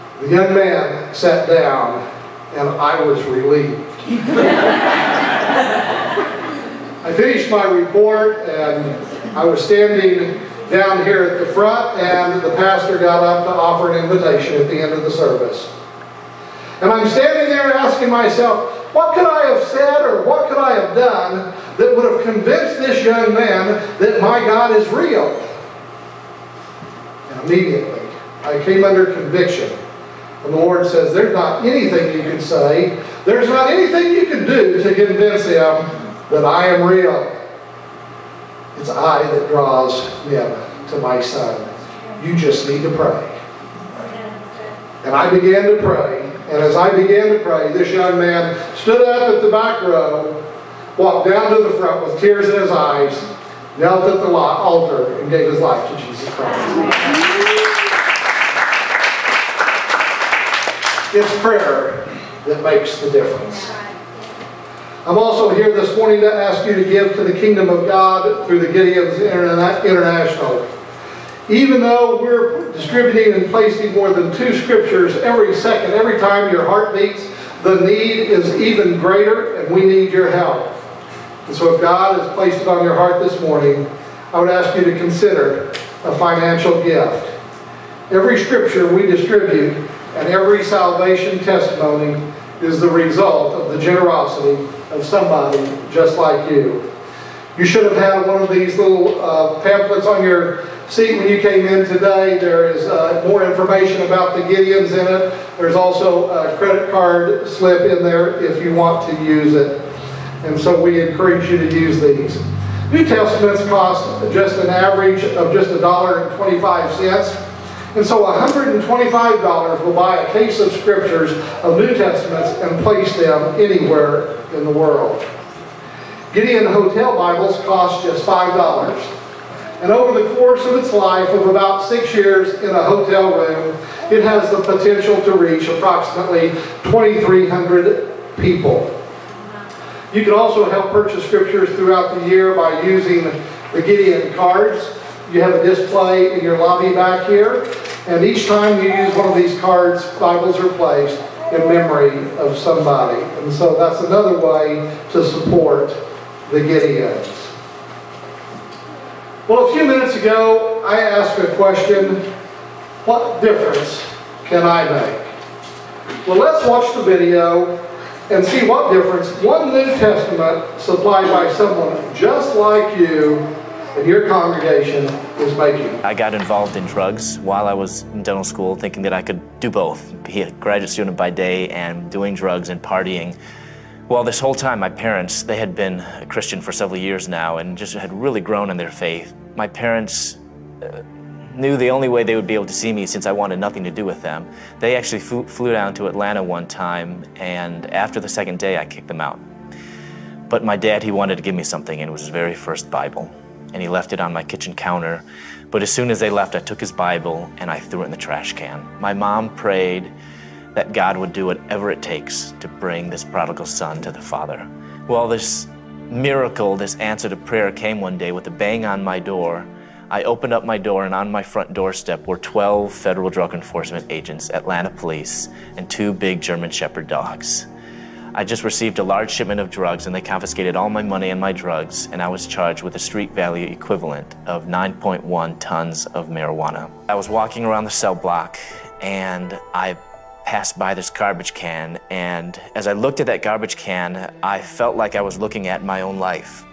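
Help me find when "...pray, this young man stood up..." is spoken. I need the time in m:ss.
0:47.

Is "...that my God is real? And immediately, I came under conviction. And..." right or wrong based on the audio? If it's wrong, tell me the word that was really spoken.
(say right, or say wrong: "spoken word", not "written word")
right.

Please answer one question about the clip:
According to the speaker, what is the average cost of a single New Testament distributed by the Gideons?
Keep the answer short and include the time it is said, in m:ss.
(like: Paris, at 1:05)
$1.25, at 1:55.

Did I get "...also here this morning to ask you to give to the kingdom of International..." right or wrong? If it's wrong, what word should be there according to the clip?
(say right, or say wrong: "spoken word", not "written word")
wrong: "God", not "International".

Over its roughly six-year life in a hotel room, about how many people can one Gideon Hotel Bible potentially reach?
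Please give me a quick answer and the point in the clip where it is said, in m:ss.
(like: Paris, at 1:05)
2,300, at 2:16.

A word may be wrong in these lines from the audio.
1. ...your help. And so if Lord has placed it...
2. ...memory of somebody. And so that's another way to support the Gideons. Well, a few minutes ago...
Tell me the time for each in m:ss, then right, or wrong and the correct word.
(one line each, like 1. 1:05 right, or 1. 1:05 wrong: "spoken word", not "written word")
1. 1:20 wrong: "God", not "Lord"
2. 2:31 right.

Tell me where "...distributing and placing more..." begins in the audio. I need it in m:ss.
1:12.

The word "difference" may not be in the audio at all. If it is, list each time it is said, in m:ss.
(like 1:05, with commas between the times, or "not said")
1:03, 2:43, 2:48.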